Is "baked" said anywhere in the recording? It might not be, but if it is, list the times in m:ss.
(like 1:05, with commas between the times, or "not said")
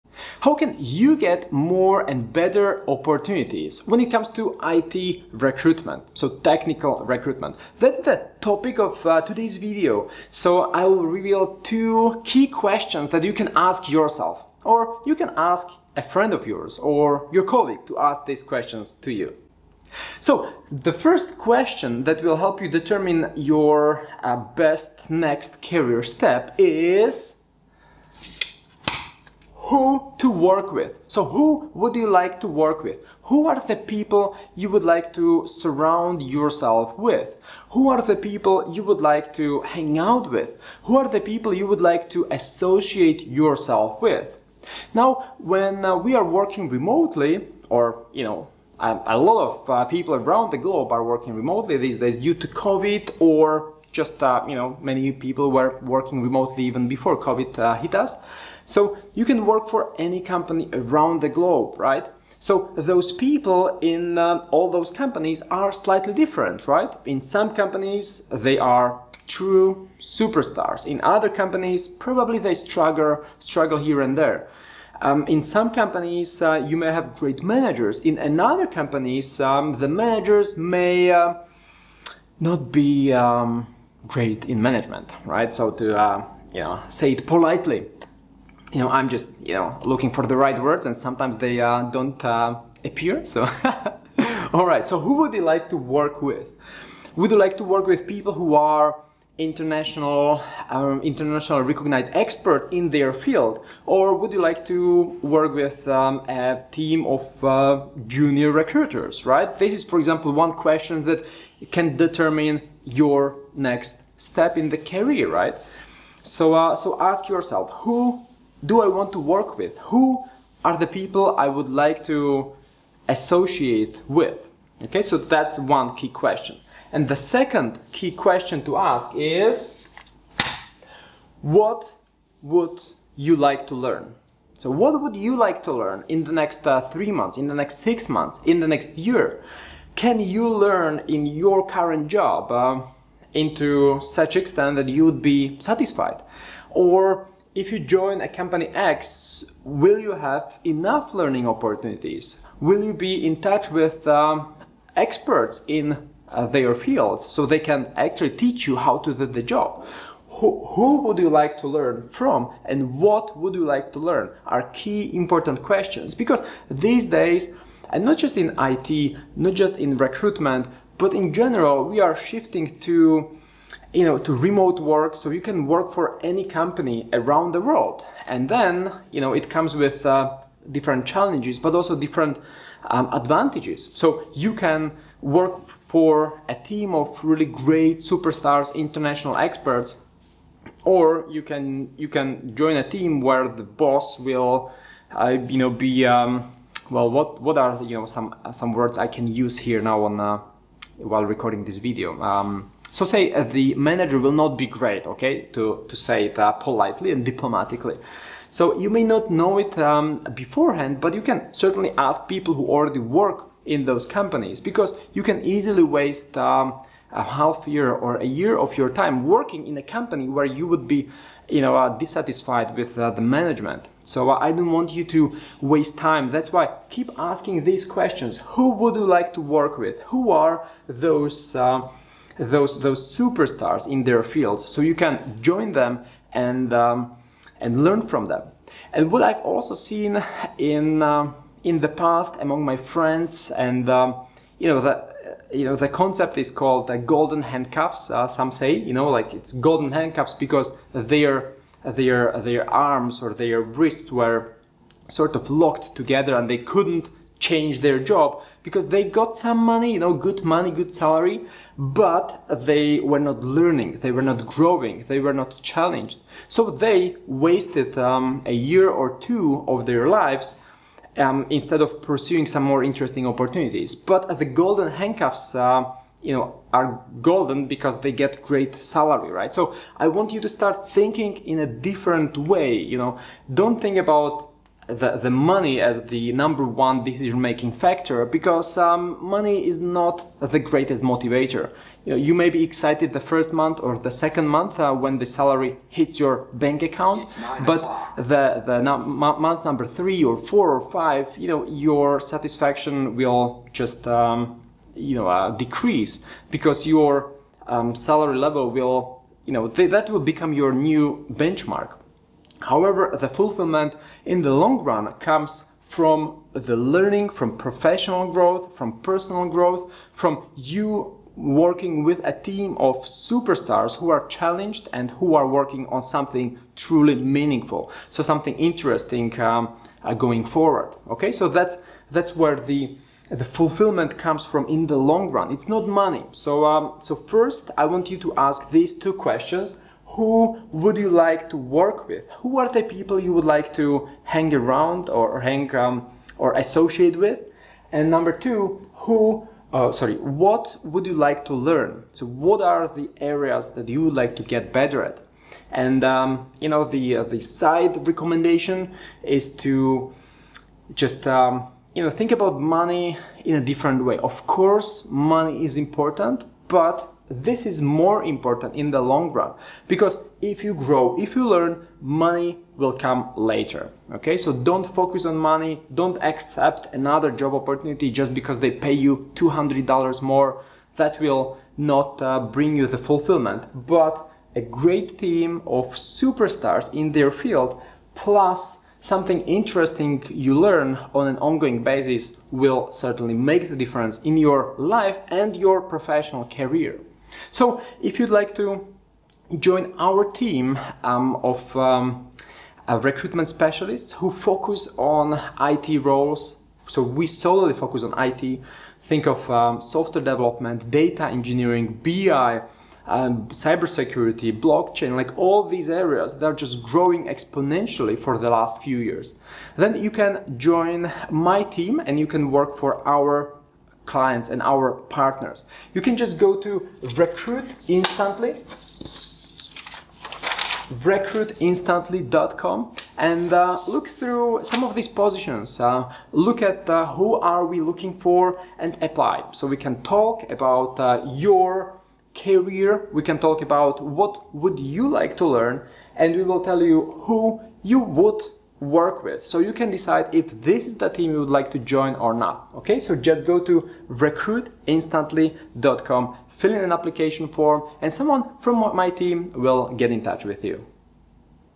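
not said.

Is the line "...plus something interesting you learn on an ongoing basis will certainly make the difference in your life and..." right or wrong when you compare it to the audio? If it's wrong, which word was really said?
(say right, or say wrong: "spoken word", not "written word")
right.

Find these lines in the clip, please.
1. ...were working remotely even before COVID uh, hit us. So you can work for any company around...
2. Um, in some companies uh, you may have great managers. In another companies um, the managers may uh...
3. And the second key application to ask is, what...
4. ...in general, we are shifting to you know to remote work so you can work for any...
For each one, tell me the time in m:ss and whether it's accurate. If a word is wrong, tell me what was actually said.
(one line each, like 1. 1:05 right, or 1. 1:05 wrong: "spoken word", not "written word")
1. 0:55 right
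2. 1:15 right
3. 2:06 wrong: "question", not "application"
4. 2:51 right.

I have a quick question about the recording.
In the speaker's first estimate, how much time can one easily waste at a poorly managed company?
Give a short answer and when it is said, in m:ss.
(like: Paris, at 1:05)
half year, at 3:37.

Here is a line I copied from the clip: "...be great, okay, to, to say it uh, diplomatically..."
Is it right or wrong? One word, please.
wrong.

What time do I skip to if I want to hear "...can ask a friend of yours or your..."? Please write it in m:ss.
0:15.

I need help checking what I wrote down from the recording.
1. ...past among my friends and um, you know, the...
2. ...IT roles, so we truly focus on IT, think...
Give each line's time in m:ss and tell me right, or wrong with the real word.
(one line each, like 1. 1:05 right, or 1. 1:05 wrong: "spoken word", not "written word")
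1. 4:01 right
2. 6:45 wrong: "solely", not "truly".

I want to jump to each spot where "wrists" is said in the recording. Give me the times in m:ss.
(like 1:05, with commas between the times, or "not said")
4:13.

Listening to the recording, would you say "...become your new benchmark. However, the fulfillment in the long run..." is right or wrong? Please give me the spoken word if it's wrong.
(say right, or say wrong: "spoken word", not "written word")
right.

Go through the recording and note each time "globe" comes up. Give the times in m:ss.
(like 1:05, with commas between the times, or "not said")
0:50, 1:01.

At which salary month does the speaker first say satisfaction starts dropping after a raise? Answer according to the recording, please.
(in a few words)
month 3.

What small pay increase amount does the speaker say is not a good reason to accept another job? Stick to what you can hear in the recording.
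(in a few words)
$200.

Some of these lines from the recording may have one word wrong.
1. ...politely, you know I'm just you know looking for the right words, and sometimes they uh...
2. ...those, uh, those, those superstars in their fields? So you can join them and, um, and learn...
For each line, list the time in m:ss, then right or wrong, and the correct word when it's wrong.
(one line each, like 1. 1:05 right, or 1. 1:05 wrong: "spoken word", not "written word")
1. 1:27 right
2. 3:50 right.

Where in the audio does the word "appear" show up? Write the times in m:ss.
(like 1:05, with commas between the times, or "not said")
1:32.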